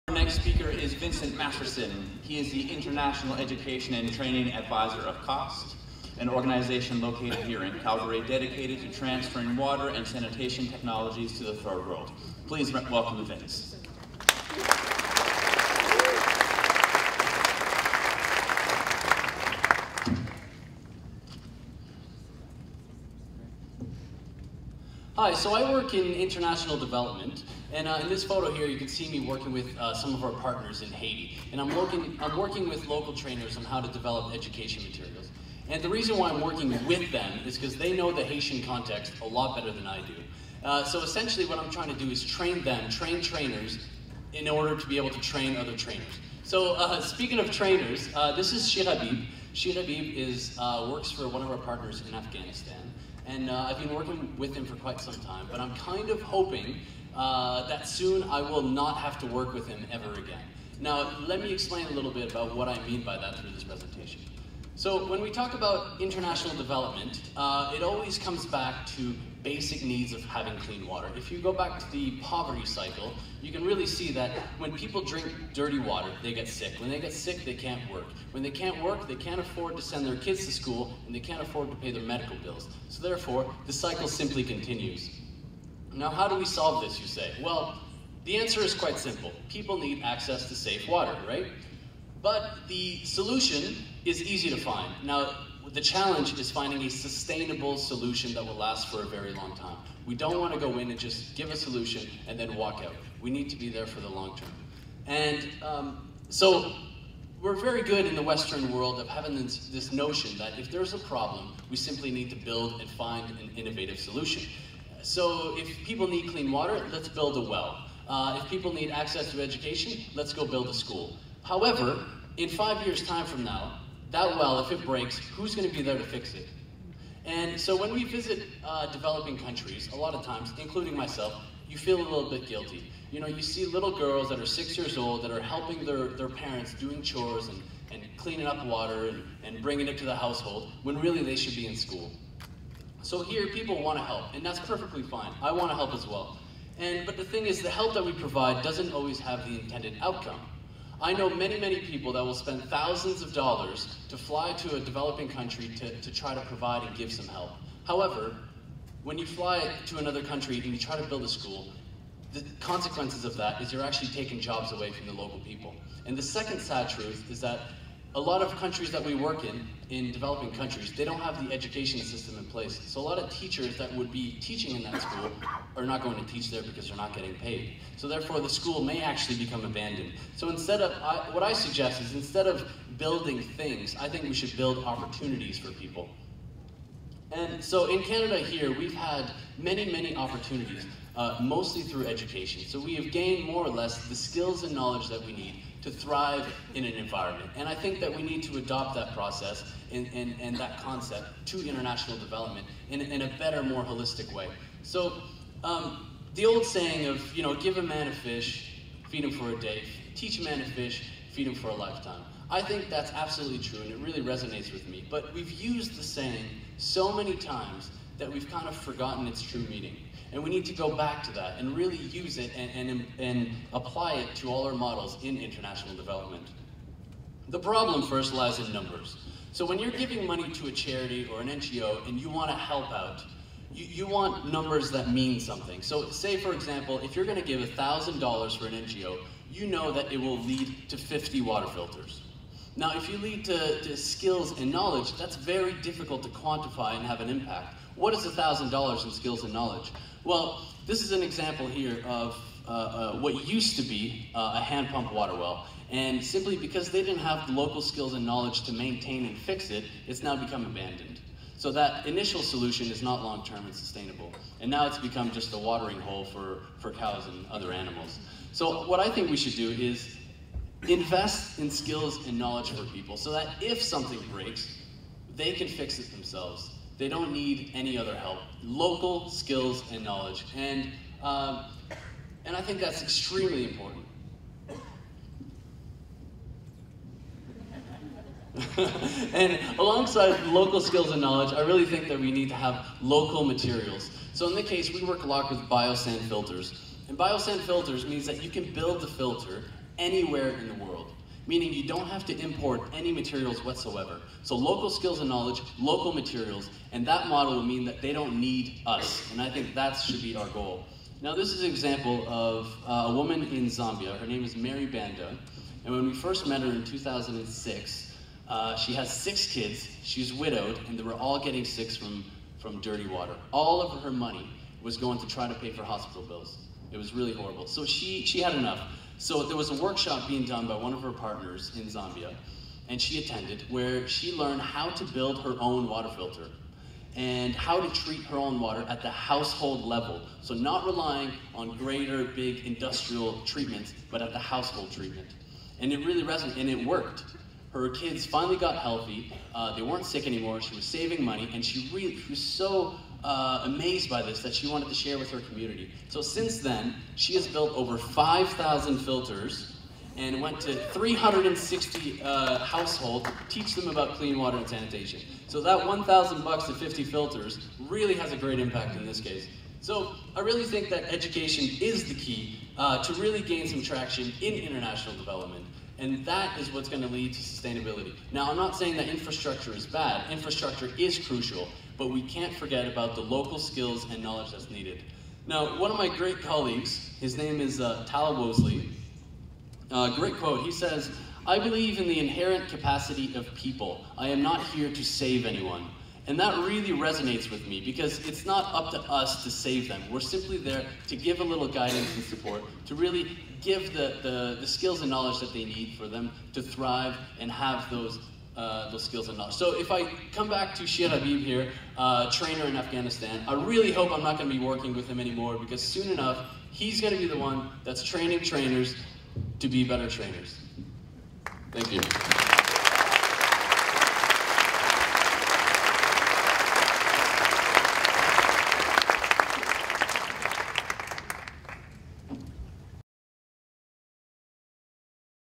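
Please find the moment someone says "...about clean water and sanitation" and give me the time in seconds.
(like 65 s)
363 s.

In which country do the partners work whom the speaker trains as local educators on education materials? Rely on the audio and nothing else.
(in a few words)
Haiti.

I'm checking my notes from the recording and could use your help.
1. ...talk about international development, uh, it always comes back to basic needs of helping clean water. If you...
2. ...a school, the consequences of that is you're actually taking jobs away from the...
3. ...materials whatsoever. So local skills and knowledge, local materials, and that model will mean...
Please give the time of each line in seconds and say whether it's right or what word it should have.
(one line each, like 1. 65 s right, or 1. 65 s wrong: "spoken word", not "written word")
1. 65 s wrong: "having", not "helping"
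2. 161 s right
3. 303 s right.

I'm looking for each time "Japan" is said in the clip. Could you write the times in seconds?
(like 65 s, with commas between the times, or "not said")
not said.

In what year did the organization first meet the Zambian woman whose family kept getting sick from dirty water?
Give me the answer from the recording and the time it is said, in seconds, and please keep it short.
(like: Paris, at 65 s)
2006, at 316 s.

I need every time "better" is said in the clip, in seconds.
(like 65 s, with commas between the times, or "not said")
39 s, 203 s, 419 s.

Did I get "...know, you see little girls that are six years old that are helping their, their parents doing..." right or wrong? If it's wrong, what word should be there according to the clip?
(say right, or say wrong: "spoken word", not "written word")
right.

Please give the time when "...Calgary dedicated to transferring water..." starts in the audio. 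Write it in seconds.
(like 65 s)
7 s.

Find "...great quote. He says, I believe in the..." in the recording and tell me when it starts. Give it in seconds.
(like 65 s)
390 s.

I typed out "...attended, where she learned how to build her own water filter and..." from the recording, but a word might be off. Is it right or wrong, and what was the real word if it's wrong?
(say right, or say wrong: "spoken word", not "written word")
right.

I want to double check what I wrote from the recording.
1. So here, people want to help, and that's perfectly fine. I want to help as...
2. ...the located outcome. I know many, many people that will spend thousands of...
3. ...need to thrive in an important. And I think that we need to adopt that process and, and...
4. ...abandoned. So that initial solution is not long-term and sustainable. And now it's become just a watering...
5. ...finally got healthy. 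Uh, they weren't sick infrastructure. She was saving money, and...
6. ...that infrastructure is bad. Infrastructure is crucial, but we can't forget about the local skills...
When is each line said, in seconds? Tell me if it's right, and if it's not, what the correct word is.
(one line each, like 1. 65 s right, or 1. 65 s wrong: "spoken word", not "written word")
1. 143 s right
2. 149 s wrong: "intended", not "located"
3. 195 s wrong: "environment", not "important"
4. 260 s right
5. 348 s wrong: "anymore", not "infrastructure"
6. 378 s right.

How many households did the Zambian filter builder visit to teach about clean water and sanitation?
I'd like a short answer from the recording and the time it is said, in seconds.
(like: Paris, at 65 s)
360, at 360 s.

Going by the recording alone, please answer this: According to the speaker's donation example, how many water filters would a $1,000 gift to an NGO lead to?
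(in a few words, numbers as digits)
50.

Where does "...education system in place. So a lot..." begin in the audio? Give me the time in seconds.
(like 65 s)
171 s.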